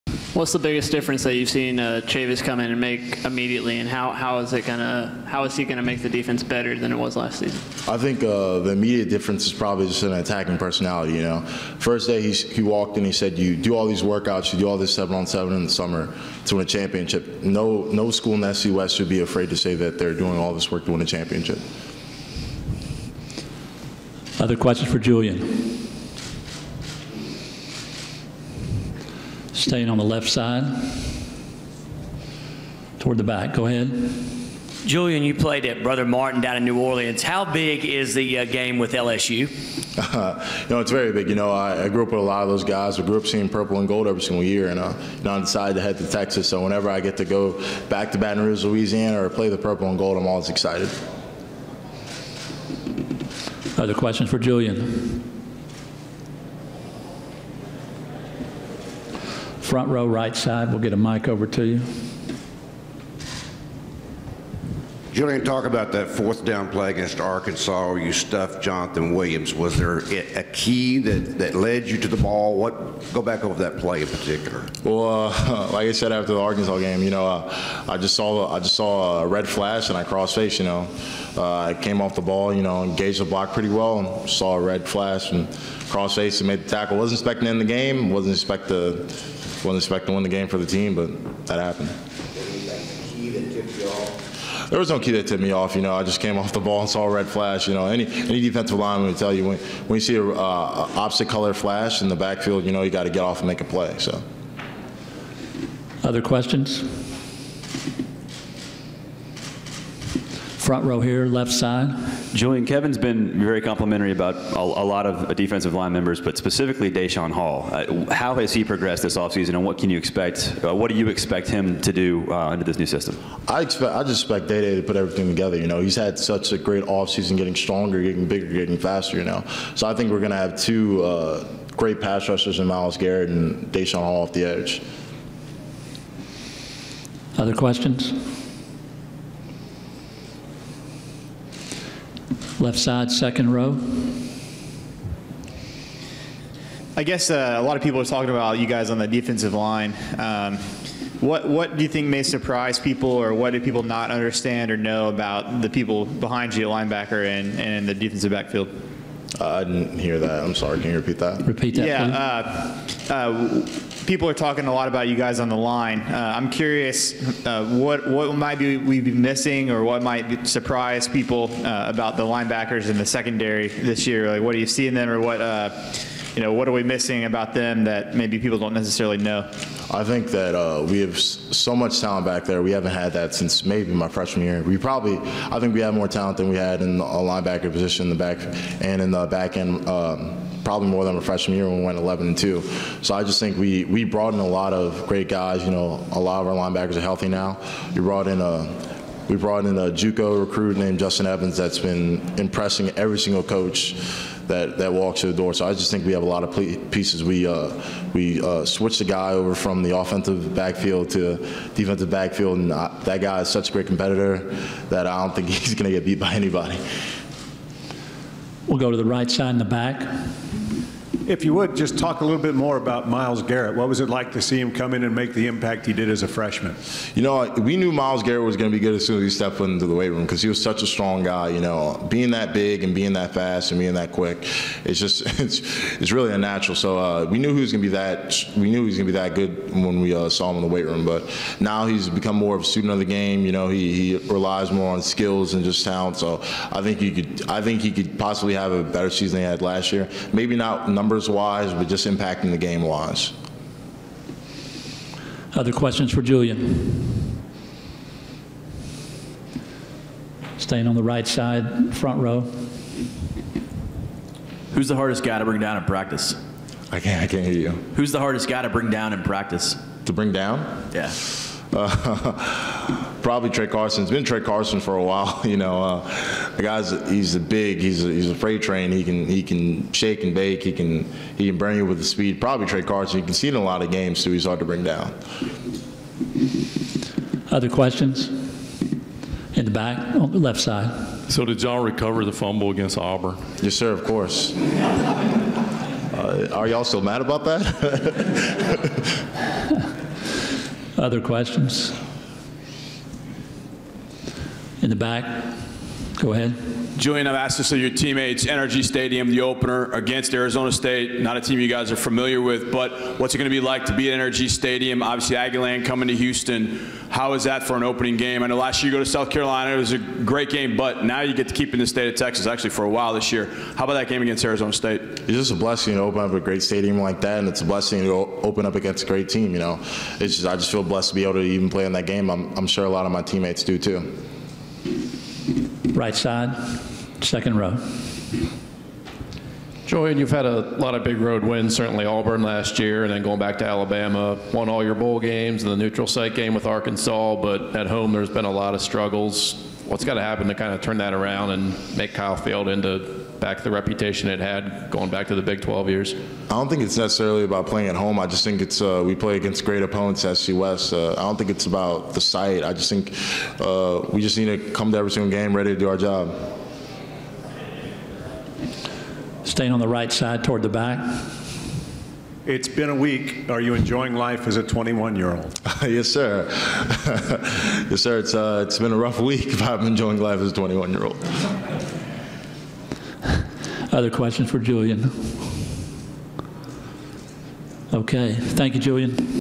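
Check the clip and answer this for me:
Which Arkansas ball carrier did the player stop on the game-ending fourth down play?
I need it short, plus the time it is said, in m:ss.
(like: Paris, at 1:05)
Jonathan Williams, at 1:08.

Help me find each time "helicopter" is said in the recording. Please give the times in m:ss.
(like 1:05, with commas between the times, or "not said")
not said.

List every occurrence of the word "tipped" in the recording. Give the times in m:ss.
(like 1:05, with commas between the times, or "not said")
1:35.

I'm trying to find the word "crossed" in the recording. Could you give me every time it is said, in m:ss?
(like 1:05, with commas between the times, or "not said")
1:20, 1:25.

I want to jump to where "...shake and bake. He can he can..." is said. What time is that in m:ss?
4:39.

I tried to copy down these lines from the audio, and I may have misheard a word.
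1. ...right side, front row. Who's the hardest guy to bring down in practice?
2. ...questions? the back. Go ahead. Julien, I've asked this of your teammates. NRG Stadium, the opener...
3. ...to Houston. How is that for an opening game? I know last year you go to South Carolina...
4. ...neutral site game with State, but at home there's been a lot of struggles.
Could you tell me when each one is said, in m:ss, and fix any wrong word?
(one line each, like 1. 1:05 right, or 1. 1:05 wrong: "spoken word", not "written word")
1. 4:21 right
2. 5:01 right
3. 5:16 right
4. 5:45 wrong: "Arkansas", not "State".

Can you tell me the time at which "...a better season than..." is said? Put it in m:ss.
4:08.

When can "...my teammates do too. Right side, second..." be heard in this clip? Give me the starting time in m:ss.
5:33.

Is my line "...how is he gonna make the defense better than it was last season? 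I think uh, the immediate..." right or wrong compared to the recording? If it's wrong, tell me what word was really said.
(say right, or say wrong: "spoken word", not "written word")
right.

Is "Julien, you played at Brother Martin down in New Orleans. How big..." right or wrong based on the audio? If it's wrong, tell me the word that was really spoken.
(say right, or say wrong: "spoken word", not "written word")
right.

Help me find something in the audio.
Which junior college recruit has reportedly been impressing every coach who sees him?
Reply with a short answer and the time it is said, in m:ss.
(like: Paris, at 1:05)
Justin Evans, at 3:20.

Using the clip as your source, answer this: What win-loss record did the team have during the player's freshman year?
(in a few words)
11 and 2.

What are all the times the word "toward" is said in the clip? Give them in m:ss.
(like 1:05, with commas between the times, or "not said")
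0:32, 6:10.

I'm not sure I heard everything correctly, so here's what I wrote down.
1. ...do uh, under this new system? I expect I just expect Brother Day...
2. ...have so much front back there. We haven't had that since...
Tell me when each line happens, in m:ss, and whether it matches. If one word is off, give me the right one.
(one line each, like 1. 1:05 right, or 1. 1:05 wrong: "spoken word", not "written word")
1. 2:01 wrong: "Day", not "Brother"
2. 3:01 wrong: "talent", not "front".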